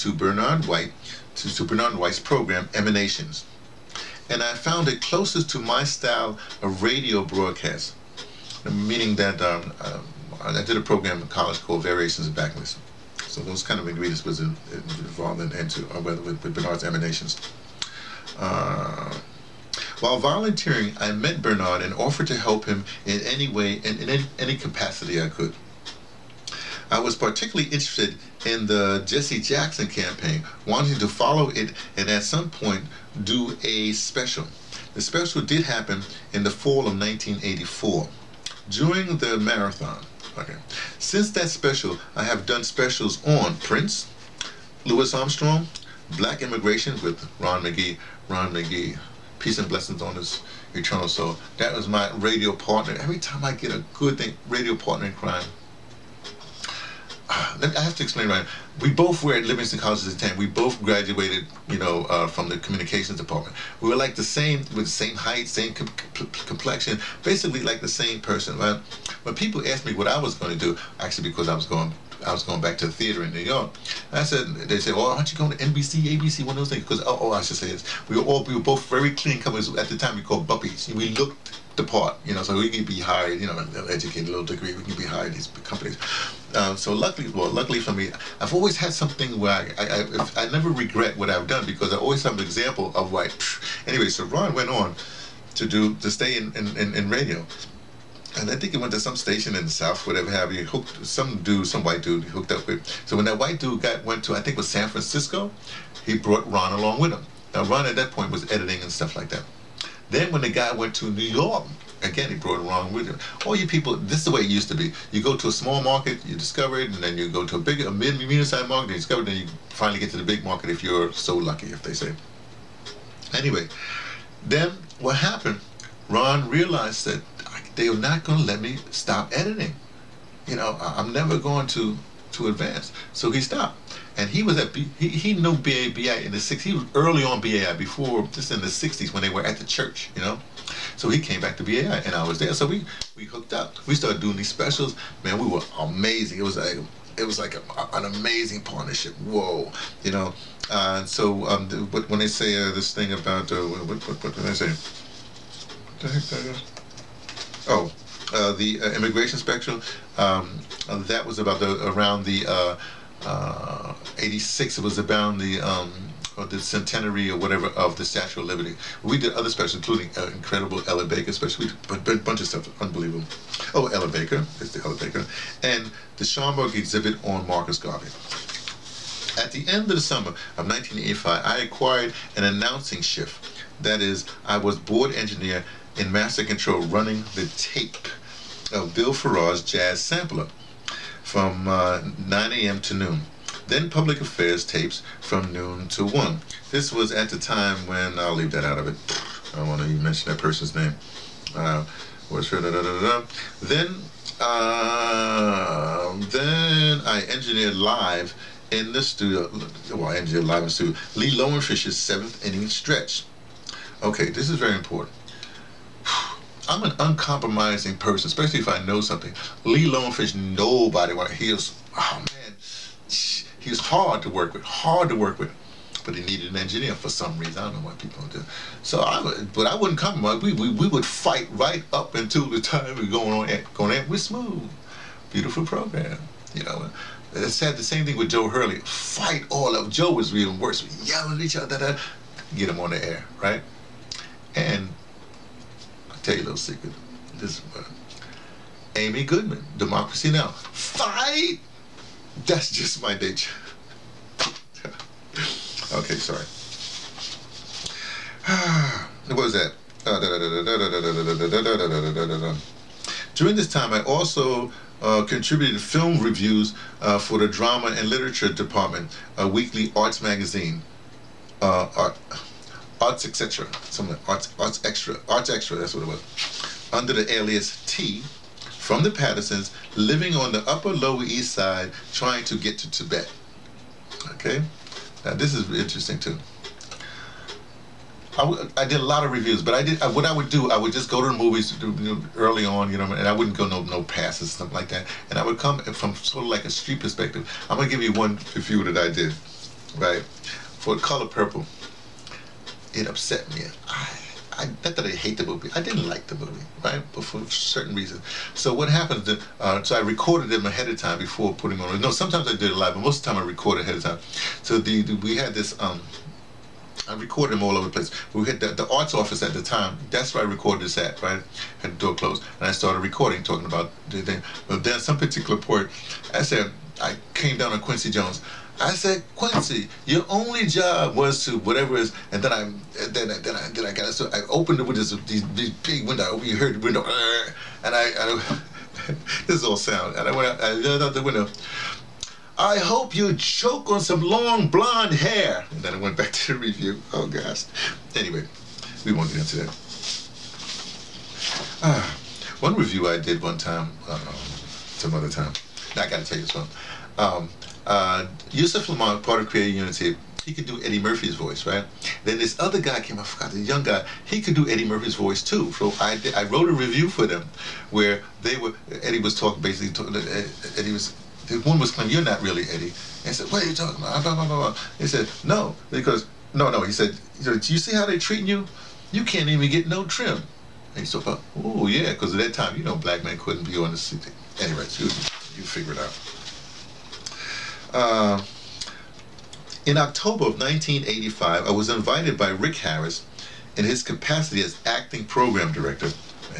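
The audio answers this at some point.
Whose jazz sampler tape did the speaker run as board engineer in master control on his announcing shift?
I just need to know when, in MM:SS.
03:08.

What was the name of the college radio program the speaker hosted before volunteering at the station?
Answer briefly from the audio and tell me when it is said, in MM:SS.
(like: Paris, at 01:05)
Variations of Backlist, at 00:11.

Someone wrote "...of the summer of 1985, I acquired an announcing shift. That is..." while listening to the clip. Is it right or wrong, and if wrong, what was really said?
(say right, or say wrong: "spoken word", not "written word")
right.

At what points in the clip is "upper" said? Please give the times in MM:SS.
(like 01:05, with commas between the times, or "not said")
04:40.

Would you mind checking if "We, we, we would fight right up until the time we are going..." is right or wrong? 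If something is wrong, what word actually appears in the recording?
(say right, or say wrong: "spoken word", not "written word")
right.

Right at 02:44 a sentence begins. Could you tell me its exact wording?
It was about the um, or the centenary or whatever of the Statue of Liberty.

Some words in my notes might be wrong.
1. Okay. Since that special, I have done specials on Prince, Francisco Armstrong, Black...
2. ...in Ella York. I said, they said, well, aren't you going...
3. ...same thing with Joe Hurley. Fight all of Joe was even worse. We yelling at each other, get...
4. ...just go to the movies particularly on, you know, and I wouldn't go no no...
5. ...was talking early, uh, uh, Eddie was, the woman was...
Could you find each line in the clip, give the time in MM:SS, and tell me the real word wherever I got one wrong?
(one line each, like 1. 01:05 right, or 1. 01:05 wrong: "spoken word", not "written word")
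1. 00:40 wrong: "Louis", not "Francisco"
2. 01:13 wrong: "New", not "Ella"
3. 03:57 right
4. 04:50 wrong: "early", not "particularly"
5. 06:09 wrong: "basically", not "early".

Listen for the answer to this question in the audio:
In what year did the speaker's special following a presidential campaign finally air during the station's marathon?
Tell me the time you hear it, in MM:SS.
00:36.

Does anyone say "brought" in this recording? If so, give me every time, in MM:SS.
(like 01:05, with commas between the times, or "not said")
01:46, 01:52.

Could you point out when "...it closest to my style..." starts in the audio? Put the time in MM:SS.
00:04.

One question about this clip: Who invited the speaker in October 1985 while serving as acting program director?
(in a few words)
Rick Harris.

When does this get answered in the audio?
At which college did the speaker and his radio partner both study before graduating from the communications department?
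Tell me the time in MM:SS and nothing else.
00:59.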